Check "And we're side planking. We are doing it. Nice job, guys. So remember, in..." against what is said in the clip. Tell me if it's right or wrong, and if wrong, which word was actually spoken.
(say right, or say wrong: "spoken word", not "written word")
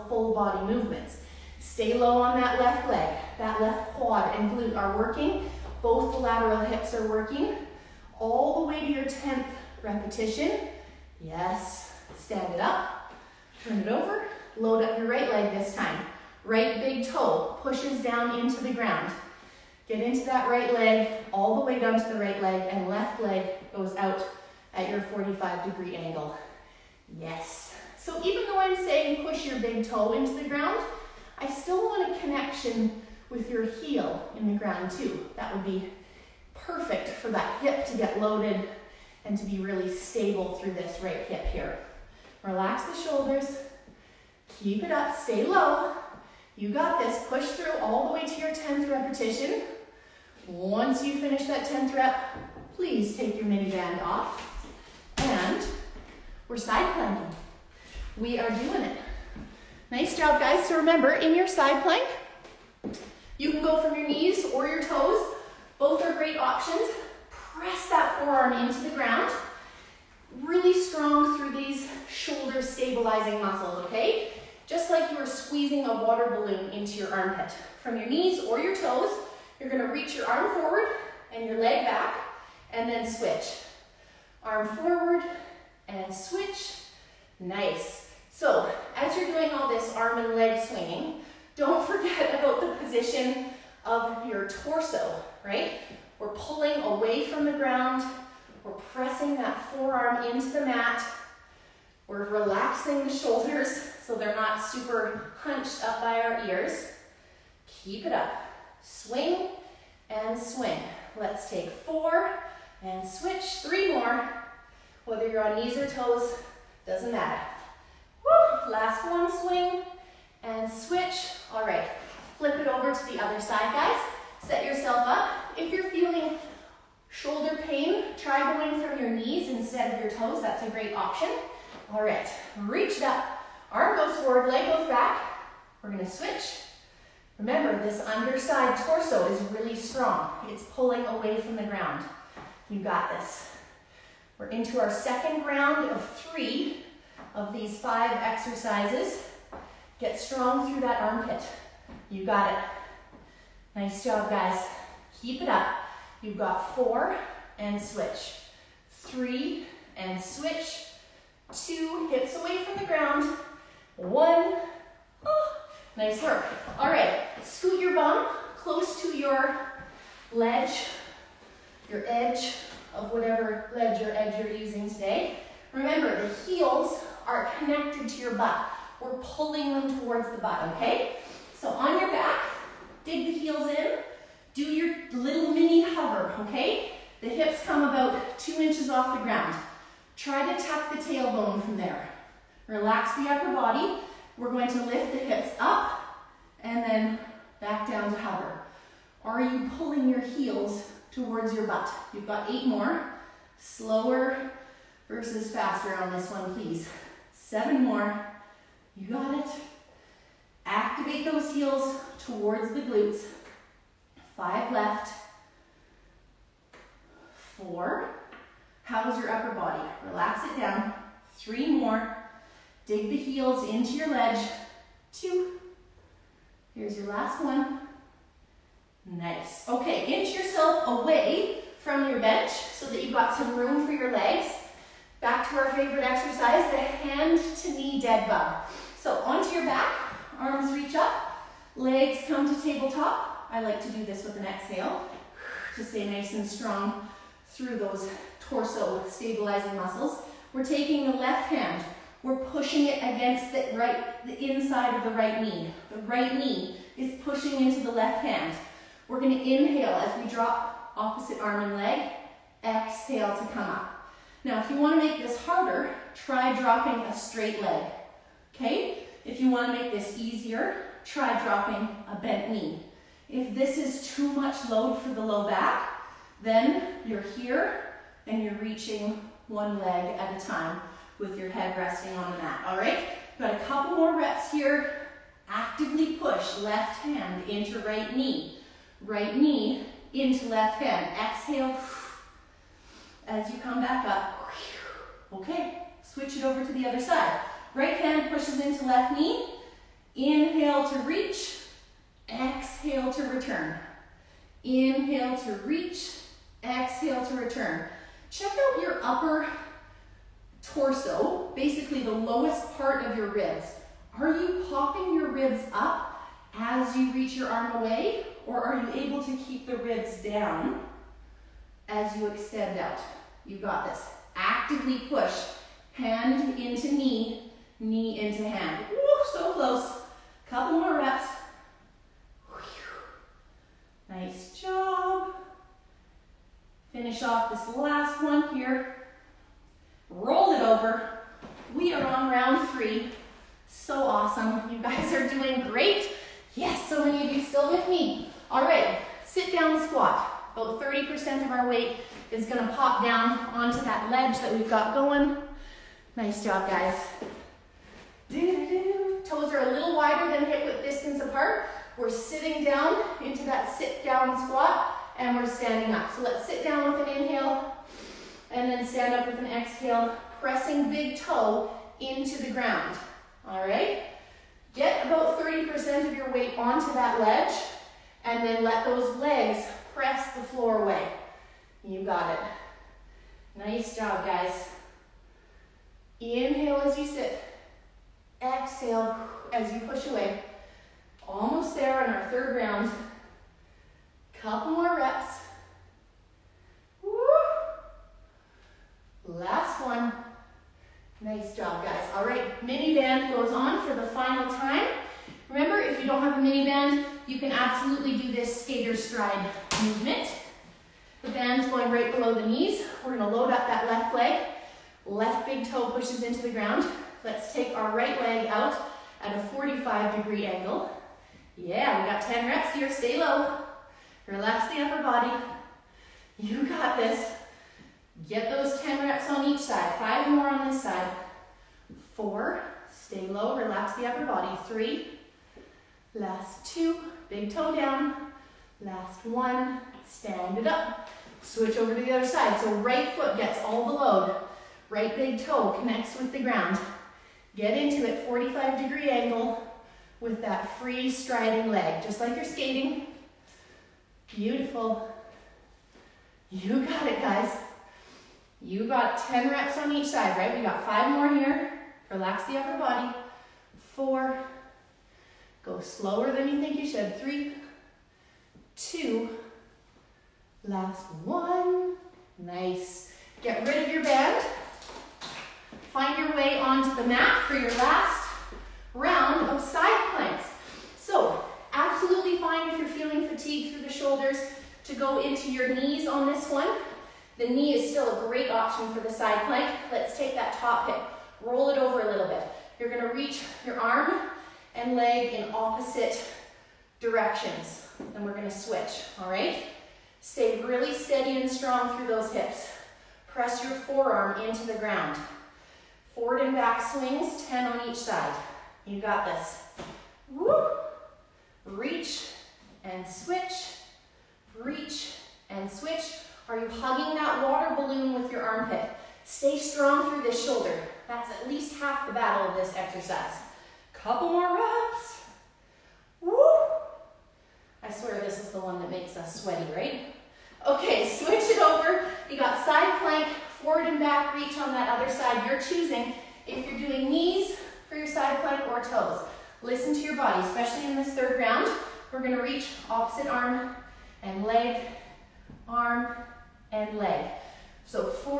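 right.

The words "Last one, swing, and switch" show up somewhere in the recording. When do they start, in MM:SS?
01:58.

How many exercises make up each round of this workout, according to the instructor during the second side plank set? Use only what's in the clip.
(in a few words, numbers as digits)
5.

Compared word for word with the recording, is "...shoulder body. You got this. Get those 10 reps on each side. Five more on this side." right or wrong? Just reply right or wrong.
wrong.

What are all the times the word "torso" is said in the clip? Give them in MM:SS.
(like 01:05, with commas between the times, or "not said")
01:34, 02:18, 04:08, 05:10.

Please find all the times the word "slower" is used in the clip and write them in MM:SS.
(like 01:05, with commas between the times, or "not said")
03:23, 07:45.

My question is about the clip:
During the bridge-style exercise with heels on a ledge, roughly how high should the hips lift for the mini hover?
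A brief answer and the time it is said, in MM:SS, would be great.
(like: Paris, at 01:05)
2 inches, at 03:08.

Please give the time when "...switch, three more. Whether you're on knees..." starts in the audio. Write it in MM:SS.
01:53.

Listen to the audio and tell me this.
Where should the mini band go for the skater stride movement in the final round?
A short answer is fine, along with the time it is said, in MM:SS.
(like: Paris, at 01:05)
right below the knees, at 06:51.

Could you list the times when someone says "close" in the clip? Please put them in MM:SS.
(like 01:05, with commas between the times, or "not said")
02:48, 05:29.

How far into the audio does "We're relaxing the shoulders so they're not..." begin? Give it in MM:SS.
01:42.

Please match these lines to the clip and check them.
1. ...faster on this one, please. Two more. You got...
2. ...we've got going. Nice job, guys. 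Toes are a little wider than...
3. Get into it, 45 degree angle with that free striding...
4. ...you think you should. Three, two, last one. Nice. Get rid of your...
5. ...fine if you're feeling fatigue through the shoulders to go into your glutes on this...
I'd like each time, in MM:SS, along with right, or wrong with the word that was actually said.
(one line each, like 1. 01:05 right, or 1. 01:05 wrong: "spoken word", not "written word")
1. 03:25 wrong: "Seven", not "Two"
2. 05:54 right
3. 07:27 right
4. 07:46 right
5. 08:02 wrong: "knees", not "glutes".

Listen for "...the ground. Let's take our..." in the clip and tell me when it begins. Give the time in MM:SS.
06:56.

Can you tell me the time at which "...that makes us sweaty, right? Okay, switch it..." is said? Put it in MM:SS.
08:48.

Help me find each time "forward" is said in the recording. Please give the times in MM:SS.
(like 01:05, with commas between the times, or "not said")
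01:20, 01:24, 02:14, 08:26, 08:53.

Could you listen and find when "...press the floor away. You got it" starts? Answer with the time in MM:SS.
06:19.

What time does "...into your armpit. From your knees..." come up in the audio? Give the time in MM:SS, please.
01:16.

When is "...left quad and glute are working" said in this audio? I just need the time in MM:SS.
00:03.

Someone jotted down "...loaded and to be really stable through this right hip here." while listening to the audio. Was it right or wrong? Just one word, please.
right.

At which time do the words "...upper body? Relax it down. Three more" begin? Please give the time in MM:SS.
03:39.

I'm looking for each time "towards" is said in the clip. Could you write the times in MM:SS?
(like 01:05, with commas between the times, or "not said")
02:59, 03:21, 03:32.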